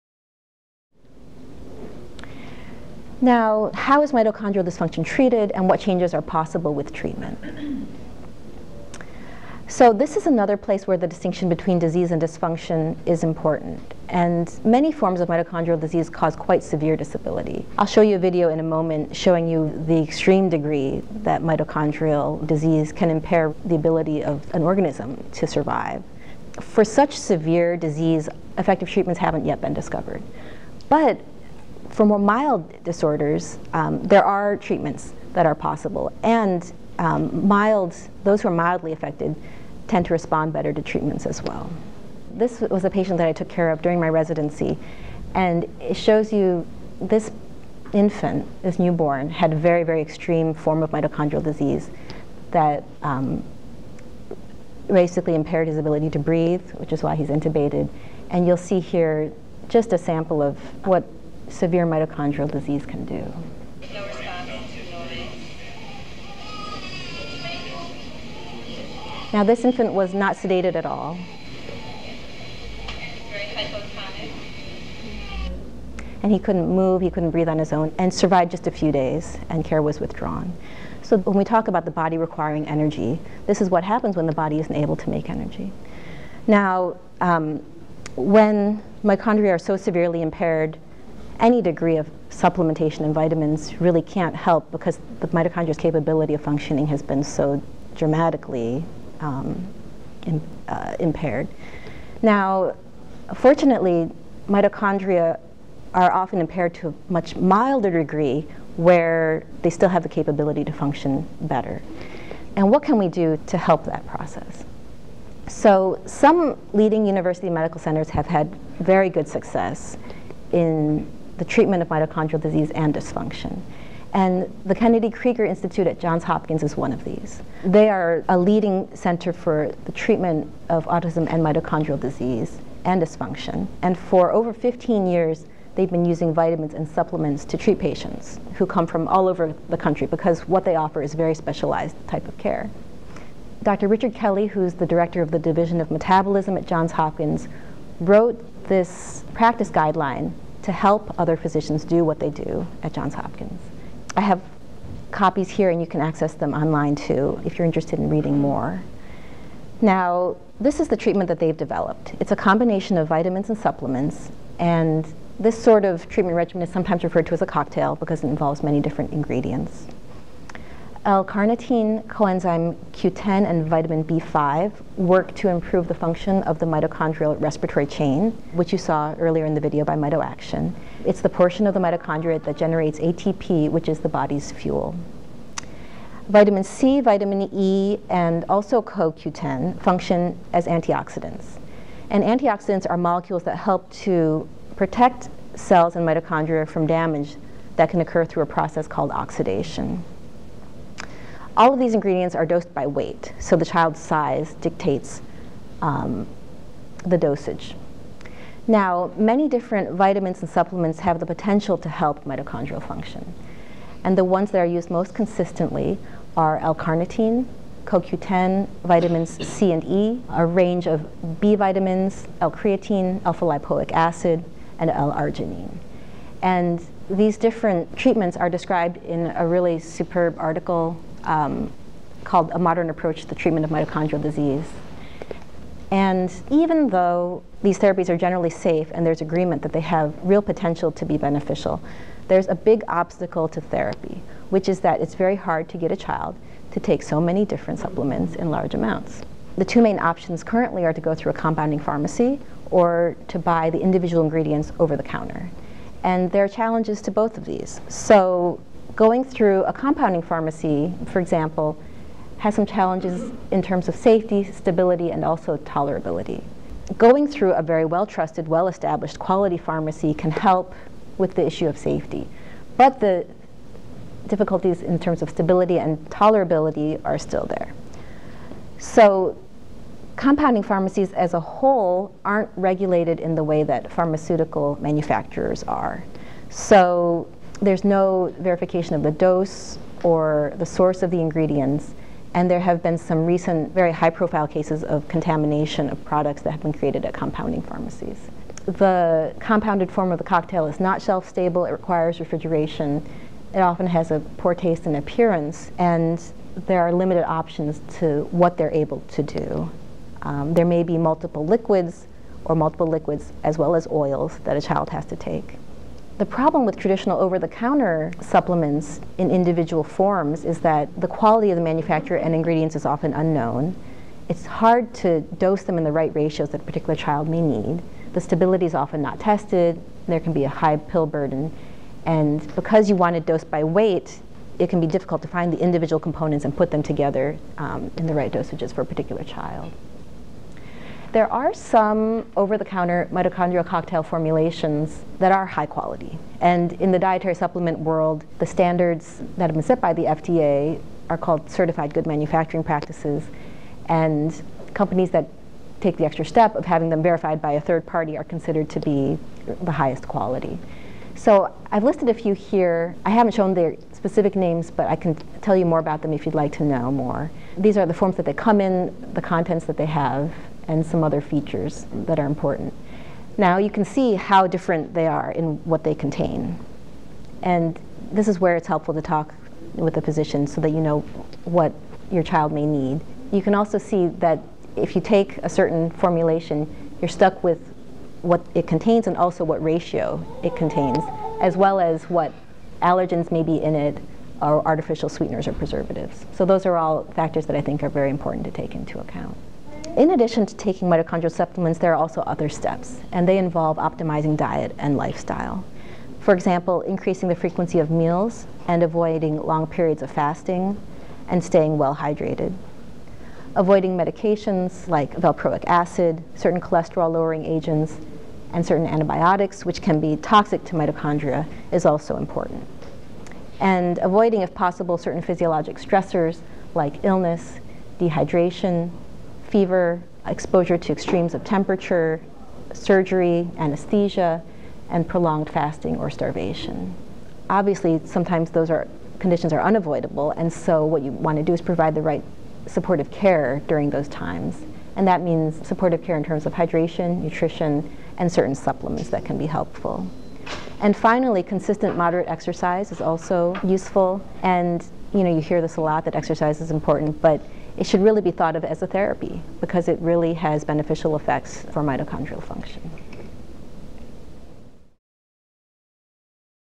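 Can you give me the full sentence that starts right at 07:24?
And that means supportive care in terms of hydration, nutrition, and certain supplements that can be helpful.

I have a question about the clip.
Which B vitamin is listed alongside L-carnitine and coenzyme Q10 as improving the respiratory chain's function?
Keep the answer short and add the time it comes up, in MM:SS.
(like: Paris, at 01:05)
vitamin B5, at 02:53.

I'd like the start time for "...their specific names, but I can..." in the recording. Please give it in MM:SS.
06:03.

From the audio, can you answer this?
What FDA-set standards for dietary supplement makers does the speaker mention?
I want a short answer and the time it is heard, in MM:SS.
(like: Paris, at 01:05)
certified good manufacturing practices, at 05:51.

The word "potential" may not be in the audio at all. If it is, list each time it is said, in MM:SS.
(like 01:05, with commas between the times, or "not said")
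03:31, 04:00.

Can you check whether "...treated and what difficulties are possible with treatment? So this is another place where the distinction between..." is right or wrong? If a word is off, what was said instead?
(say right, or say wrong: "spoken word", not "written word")
wrong: "changes", not "difficulties".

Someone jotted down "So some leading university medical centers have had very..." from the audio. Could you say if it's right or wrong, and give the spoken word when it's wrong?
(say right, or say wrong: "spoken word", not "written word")
right.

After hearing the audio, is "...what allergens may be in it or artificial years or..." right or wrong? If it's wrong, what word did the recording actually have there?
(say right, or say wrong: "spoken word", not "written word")
wrong: "sweeteners", not "years".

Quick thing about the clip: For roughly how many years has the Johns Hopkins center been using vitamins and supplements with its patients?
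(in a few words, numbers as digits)
over 15 years.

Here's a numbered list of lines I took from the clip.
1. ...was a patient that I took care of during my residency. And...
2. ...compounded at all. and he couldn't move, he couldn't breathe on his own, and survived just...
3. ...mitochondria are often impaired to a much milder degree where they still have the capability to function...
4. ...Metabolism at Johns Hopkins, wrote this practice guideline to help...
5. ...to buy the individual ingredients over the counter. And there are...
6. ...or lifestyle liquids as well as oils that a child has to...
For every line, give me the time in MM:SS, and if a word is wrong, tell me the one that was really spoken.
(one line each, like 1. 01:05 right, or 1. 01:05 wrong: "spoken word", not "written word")
1. 00:42 right
2. 01:10 wrong: "sedated", not "compounded"
3. 01:44 right
4. 02:25 right
5. 04:13 right
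6. 05:12 wrong: "multiple", not "lifestyle".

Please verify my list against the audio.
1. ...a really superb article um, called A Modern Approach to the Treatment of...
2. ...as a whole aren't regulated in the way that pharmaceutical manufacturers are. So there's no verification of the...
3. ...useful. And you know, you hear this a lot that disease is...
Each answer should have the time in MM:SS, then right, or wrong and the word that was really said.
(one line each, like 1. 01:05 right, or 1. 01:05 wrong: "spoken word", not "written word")
1. 03:49 right
2. 04:41 right
3. 07:33 wrong: "exercise", not "disease".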